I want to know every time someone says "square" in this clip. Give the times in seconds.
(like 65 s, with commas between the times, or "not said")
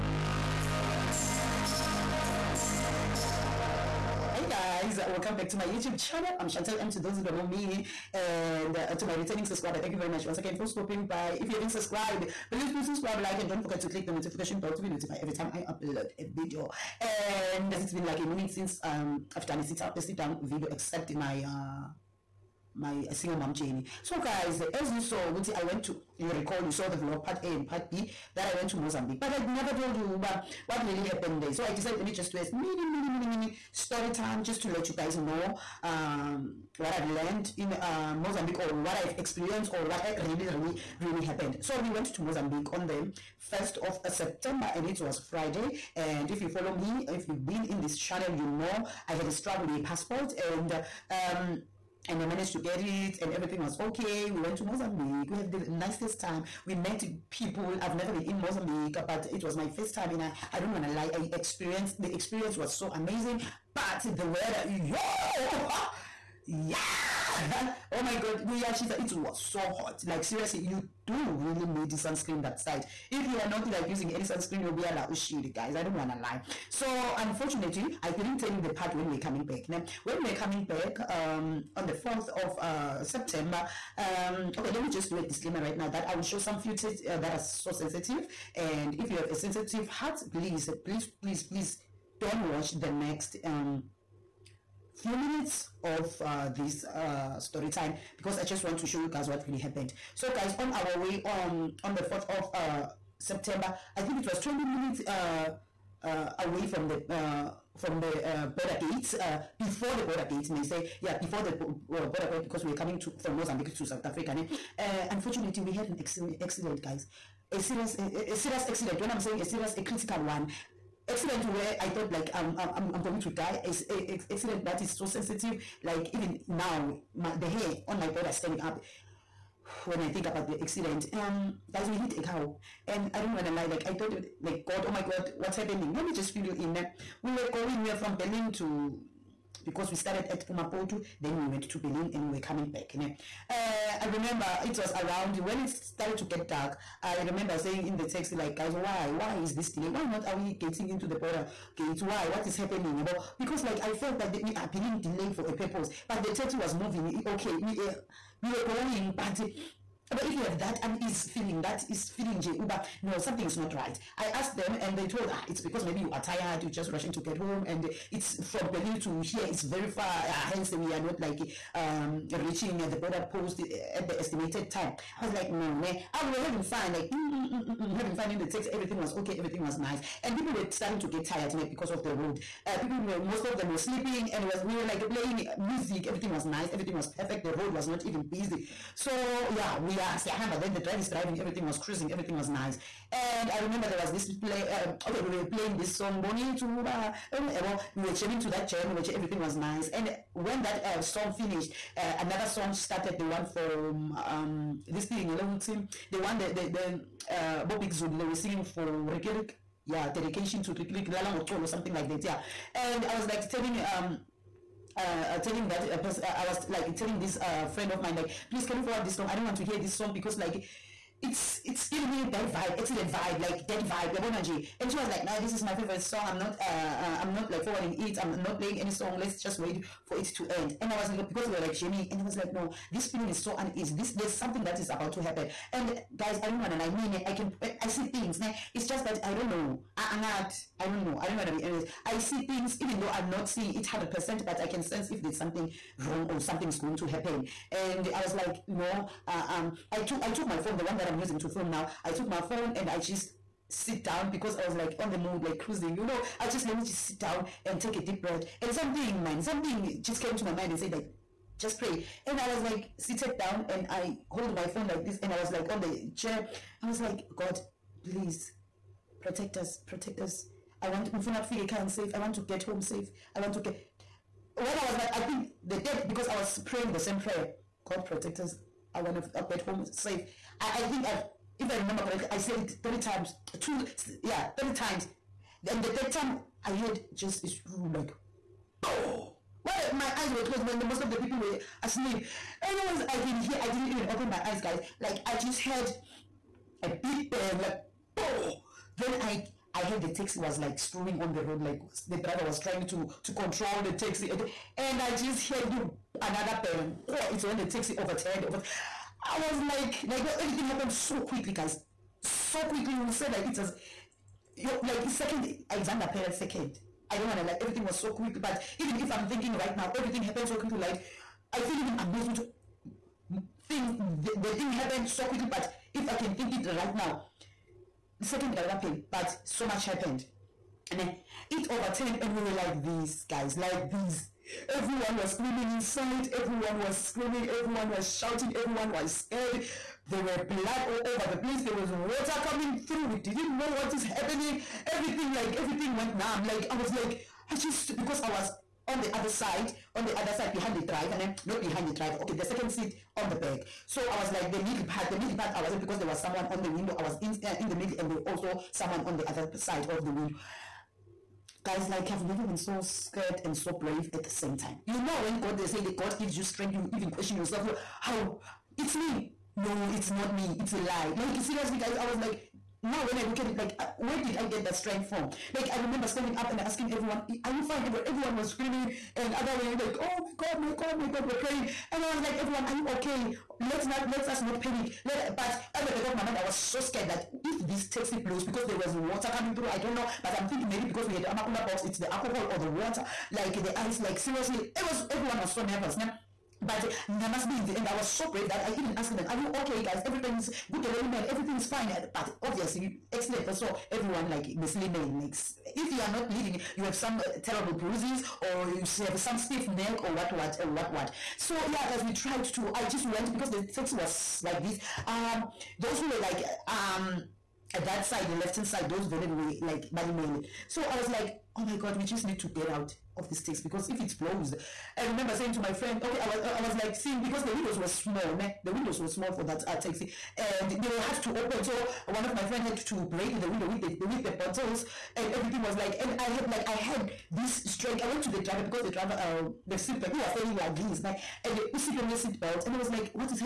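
not said.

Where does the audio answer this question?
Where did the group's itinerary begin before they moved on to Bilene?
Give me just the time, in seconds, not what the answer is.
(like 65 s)
140 s.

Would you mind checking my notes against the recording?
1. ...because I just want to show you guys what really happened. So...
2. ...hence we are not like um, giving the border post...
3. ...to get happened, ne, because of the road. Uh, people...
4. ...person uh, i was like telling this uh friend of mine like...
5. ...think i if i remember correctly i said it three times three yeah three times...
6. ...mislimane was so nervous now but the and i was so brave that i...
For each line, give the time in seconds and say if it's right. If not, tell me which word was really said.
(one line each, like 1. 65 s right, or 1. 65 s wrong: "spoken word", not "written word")
1. 98 s right
2. 170 s wrong: "reaching", not "giving"
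3. 180 s wrong: "tired", not "happened"
4. 215 s right
5. 280 s wrong: "two", not "three"
6. 395 s wrong: "everyone", not "mislimane".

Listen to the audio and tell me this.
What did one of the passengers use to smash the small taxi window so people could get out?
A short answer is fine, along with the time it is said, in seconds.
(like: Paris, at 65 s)
Bottles, at 434 s.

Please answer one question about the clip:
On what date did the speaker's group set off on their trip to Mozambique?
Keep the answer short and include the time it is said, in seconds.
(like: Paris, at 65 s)
1st of September, at 43 s.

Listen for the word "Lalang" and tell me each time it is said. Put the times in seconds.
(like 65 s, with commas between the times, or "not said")
211 s.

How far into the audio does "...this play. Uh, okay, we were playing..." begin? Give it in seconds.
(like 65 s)
194 s.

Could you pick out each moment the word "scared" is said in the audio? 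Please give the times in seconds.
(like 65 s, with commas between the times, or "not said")
339 s, 362 s, 386 s.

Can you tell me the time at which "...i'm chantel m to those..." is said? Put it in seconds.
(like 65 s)
6 s.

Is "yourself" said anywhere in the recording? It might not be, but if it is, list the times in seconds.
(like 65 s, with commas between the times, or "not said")
367 s.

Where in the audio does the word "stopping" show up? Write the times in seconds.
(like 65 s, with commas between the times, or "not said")
10 s.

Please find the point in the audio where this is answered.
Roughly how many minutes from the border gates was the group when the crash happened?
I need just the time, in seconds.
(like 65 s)
104 s.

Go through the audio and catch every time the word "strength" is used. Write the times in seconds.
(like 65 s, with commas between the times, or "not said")
366 s, 374 s, 437 s.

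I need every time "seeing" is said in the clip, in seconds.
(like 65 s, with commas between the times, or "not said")
243 s, 426 s.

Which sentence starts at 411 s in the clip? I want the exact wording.
So, yeah, because we tried to, I just went because the taxi was like this.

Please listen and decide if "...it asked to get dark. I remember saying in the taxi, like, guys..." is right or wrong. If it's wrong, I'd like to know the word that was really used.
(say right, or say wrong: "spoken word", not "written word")
wrong: "started", not "asked".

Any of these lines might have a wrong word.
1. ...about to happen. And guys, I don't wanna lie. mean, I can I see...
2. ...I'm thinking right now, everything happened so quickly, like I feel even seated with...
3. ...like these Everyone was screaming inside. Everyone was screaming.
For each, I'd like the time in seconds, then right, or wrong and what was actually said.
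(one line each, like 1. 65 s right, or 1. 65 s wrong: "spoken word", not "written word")
1. 234 s right
2. 319 s wrong: "amazed", not "seated"
3. 333 s right.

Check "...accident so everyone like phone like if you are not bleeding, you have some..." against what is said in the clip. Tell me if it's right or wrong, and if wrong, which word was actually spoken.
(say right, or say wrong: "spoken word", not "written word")
wrong: "mislimane", not "phone".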